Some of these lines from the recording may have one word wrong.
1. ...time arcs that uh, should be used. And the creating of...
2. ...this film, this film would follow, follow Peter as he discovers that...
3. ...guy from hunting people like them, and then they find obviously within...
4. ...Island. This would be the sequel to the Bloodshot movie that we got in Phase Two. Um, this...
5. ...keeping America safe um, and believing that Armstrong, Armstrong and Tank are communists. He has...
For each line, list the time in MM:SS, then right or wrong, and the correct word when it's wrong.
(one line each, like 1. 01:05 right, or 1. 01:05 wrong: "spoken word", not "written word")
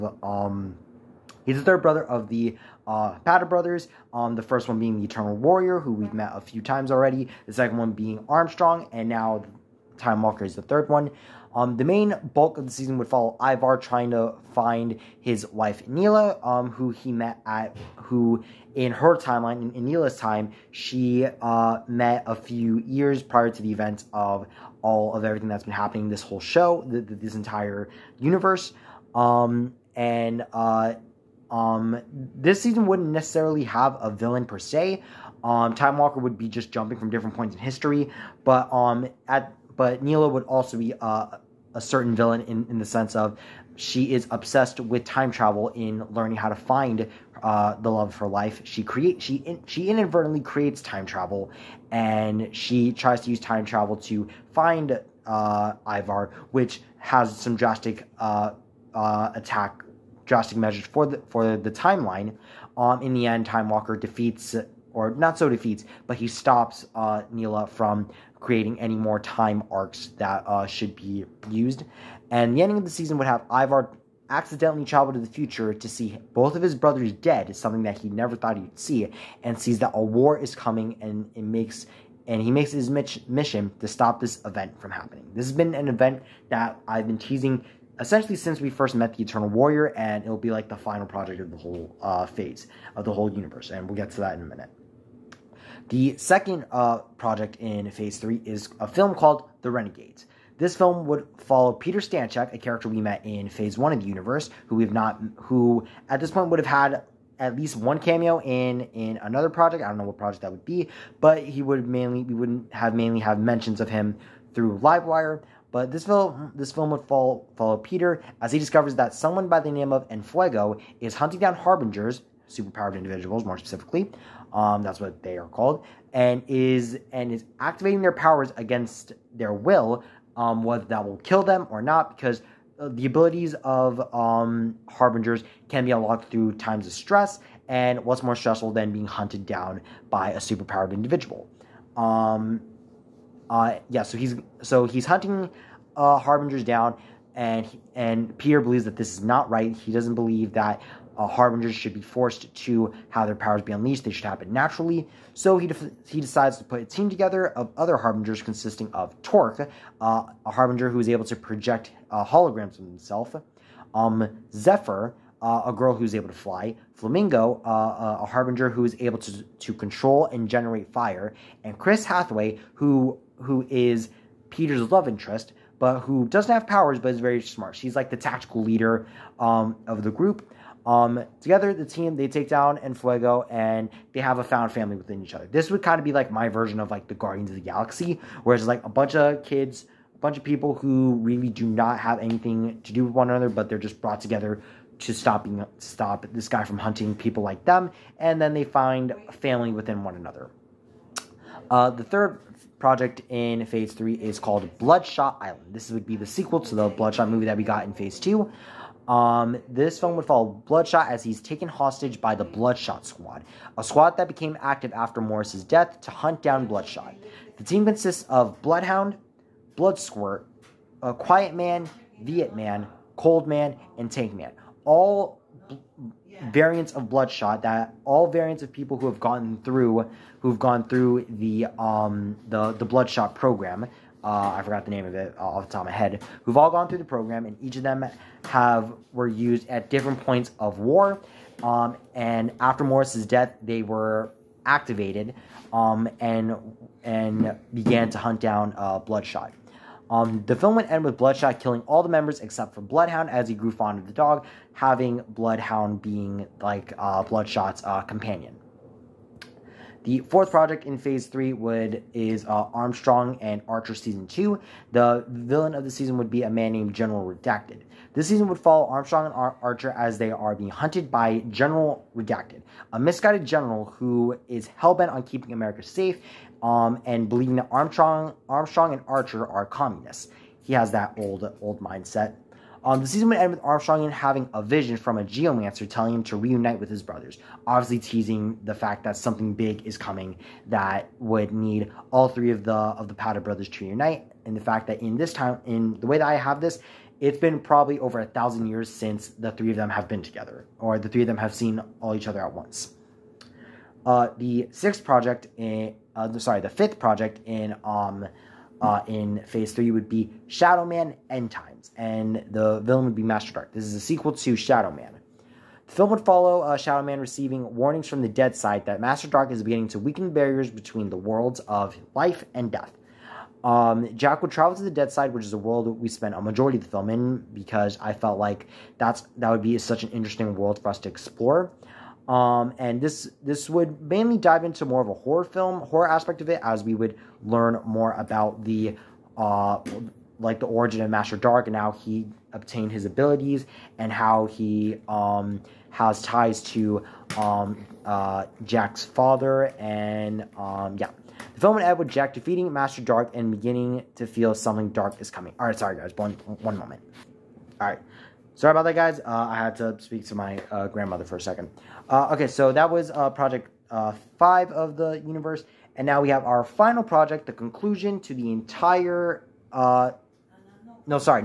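1. 01:09 wrong: "ending", not "creating"
2. 01:55 right
3. 03:16 wrong: "family", not "obviously"
4. 03:25 right
5. 04:35 wrong: "Archer", not "Tank".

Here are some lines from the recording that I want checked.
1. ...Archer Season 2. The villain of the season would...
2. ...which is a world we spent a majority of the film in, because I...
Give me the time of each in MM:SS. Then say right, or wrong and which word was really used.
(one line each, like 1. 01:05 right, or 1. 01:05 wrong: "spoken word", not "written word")
1. 04:23 right
2. 05:25 right.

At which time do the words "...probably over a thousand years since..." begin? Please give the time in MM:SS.
04:57.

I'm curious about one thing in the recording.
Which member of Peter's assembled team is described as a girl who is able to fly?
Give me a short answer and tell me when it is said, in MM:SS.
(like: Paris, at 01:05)
Zephyr, at 02:44.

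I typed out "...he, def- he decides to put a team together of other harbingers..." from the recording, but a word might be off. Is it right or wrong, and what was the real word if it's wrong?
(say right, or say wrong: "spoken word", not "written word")
right.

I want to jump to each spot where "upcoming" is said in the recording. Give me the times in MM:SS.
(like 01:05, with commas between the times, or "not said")
not said.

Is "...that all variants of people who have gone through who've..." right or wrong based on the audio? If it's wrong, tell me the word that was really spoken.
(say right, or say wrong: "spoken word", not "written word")
right.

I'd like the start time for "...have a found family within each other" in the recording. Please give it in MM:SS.
03:04.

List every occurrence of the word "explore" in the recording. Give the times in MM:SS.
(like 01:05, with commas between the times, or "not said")
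05:31.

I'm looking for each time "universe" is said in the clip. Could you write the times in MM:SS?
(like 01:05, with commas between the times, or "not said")
00:28, 01:33, 01:44, 06:05.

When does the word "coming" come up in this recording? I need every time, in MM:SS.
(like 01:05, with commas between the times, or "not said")
01:20, 04:49, 05:55.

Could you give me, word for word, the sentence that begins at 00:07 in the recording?
The second one being Armstrong, and now Time Walker is the third one.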